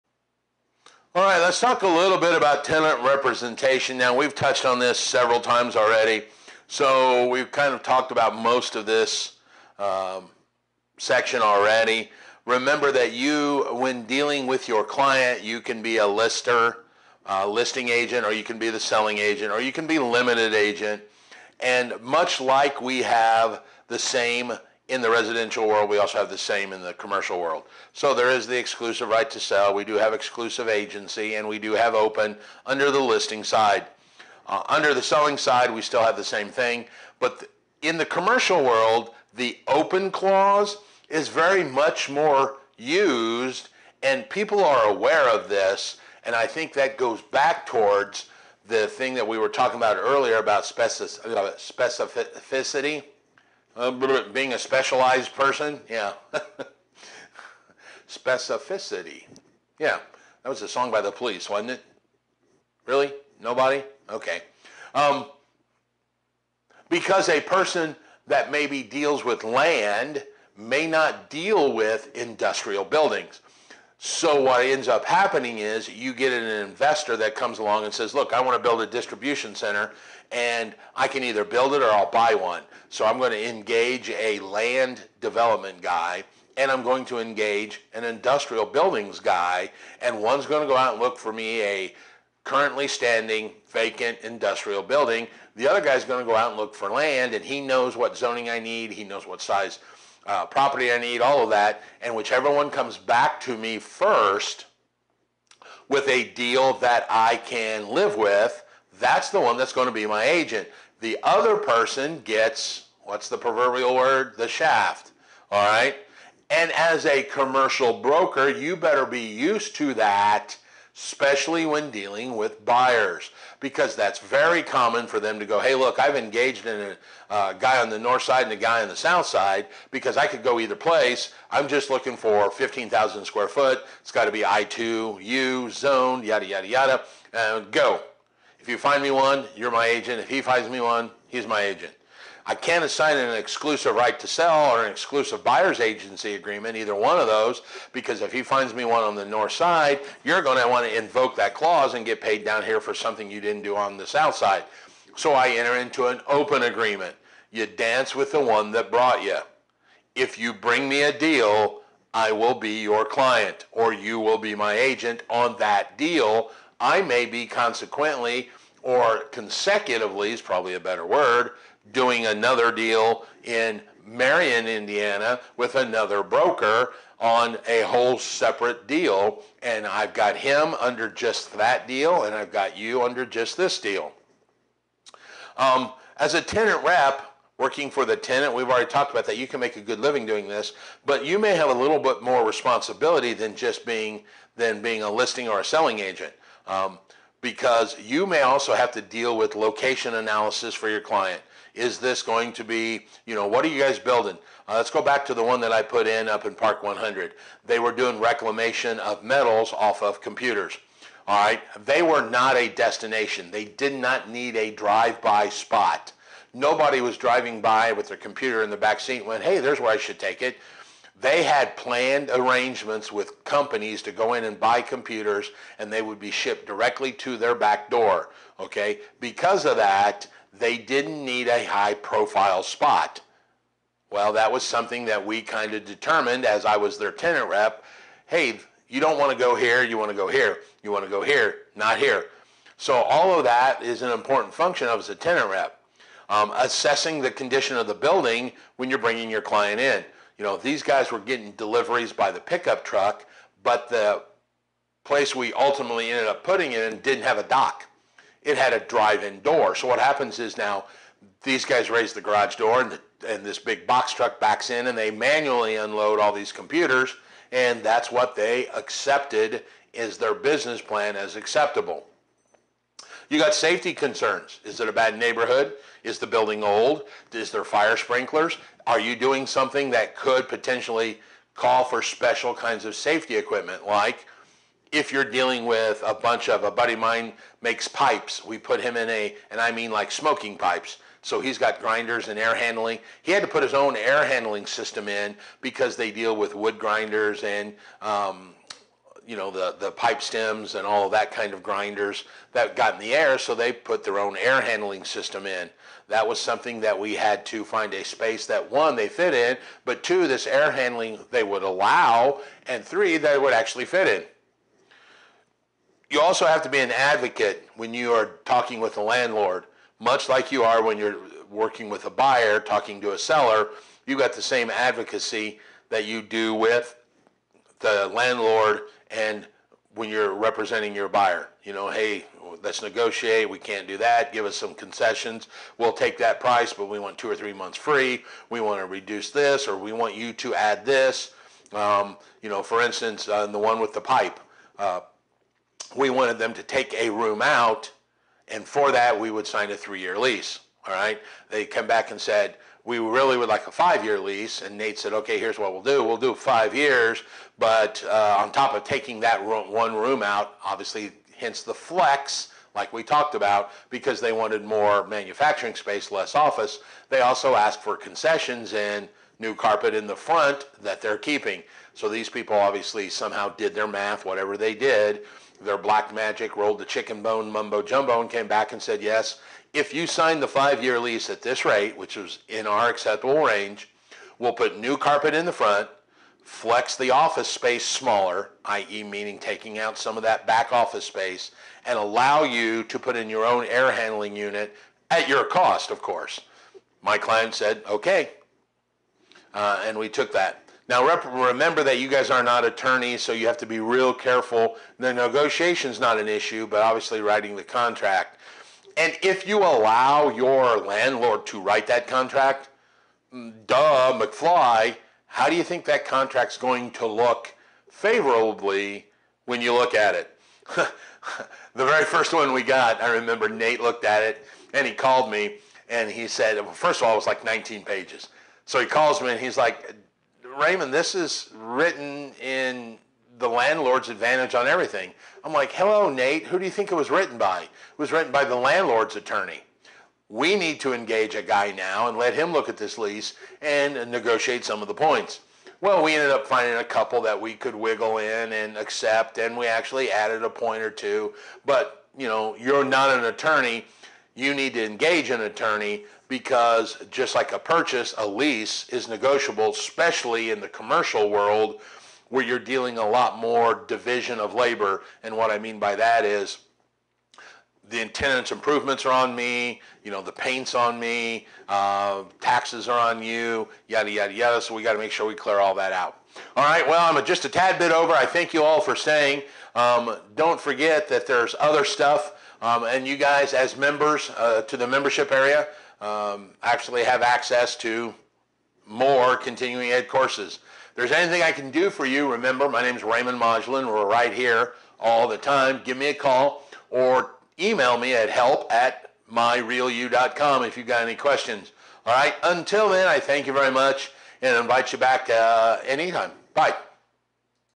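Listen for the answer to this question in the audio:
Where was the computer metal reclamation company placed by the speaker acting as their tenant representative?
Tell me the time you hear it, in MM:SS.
03:26.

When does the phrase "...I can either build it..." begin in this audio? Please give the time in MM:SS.
01:20.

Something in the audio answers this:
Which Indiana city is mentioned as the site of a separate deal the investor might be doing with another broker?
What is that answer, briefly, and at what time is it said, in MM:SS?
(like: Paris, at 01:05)
Marion, Indiana, at 02:54.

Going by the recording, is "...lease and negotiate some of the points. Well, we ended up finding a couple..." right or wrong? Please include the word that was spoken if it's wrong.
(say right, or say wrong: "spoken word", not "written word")
right.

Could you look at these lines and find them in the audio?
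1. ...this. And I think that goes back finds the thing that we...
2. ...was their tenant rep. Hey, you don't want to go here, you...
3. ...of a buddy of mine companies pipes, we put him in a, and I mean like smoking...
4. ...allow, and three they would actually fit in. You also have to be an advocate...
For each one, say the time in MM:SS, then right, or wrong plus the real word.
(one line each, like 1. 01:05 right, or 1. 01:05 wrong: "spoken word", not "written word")
1. 00:45 wrong: "towards", not "finds"
2. 03:56 right
3. 04:46 wrong: "makes", not "companies"
4. 05:11 right.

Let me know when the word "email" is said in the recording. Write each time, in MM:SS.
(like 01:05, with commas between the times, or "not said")
08:17.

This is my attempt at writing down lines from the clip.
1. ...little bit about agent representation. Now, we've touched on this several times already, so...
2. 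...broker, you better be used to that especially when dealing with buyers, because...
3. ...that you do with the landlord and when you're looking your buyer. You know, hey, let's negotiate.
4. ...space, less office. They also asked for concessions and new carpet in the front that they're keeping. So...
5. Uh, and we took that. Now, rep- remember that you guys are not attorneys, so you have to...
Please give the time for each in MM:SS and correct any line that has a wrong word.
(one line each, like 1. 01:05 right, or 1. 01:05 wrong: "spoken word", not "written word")
1. 00:01 wrong: "tenant", not "agent"
2. 01:58 right
3. 05:25 wrong: "representing", not "looking"
4. 06:05 right
5. 06:39 right.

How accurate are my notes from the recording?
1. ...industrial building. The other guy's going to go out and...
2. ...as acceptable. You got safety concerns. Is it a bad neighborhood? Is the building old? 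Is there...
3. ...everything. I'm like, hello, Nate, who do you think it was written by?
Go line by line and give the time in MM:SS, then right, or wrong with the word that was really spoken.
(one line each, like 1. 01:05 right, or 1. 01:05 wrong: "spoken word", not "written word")
1. 01:34 right
2. 04:31 right
3. 07:14 right.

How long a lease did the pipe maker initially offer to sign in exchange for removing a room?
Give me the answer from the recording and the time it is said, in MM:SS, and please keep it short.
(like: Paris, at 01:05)
3 years, at 05:49.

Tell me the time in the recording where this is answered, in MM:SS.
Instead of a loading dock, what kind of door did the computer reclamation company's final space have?
04:18.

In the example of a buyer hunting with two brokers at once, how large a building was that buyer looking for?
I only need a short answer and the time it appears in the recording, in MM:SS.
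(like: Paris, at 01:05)
15,000 square feet, at 02:12.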